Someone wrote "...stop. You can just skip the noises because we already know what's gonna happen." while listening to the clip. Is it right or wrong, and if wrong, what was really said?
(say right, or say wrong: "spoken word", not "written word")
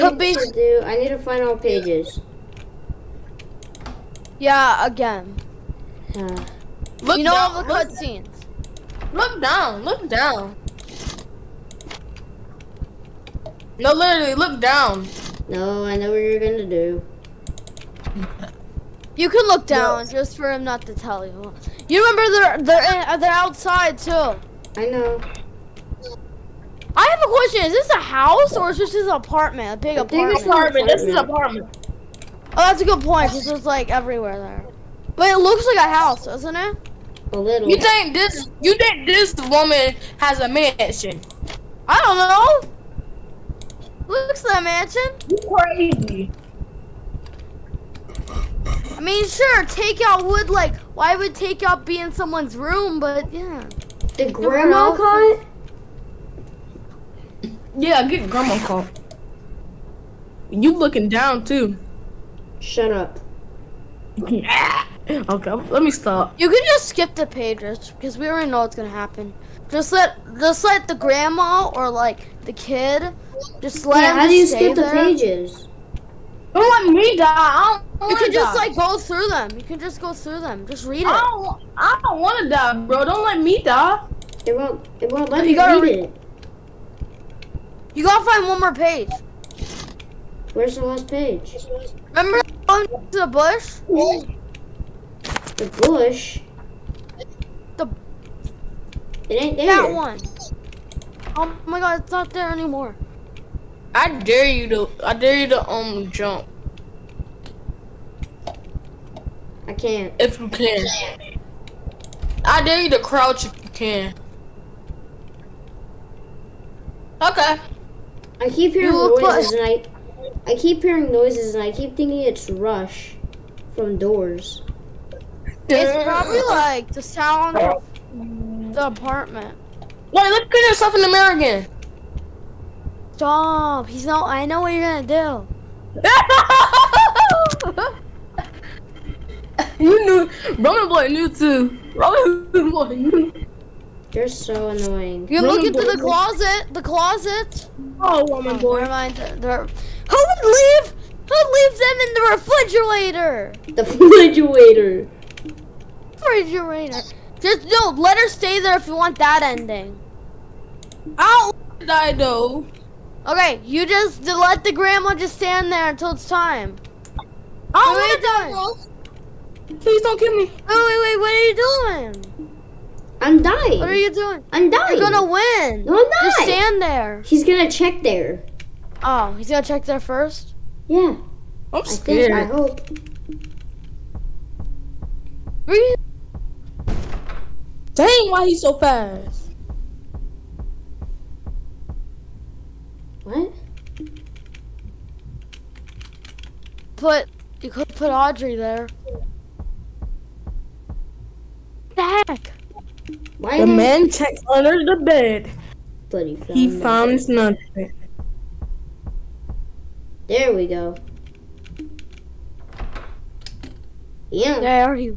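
wrong: "pages", not "noises".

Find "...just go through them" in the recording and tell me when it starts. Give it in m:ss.
1:19.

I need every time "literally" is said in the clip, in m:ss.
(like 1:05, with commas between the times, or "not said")
0:13.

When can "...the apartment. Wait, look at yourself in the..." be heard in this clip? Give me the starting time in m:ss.
2:08.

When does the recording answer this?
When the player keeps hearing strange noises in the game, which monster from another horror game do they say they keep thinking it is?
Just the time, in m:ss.
2:02.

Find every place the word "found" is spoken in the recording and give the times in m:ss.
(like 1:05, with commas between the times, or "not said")
3:26.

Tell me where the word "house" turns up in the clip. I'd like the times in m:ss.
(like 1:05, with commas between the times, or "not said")
0:28, 0:35.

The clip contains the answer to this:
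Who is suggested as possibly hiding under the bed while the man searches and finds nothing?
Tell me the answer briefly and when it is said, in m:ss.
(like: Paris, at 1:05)
Audrey, at 3:18.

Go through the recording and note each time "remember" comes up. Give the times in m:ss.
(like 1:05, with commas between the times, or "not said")
0:22, 1:32.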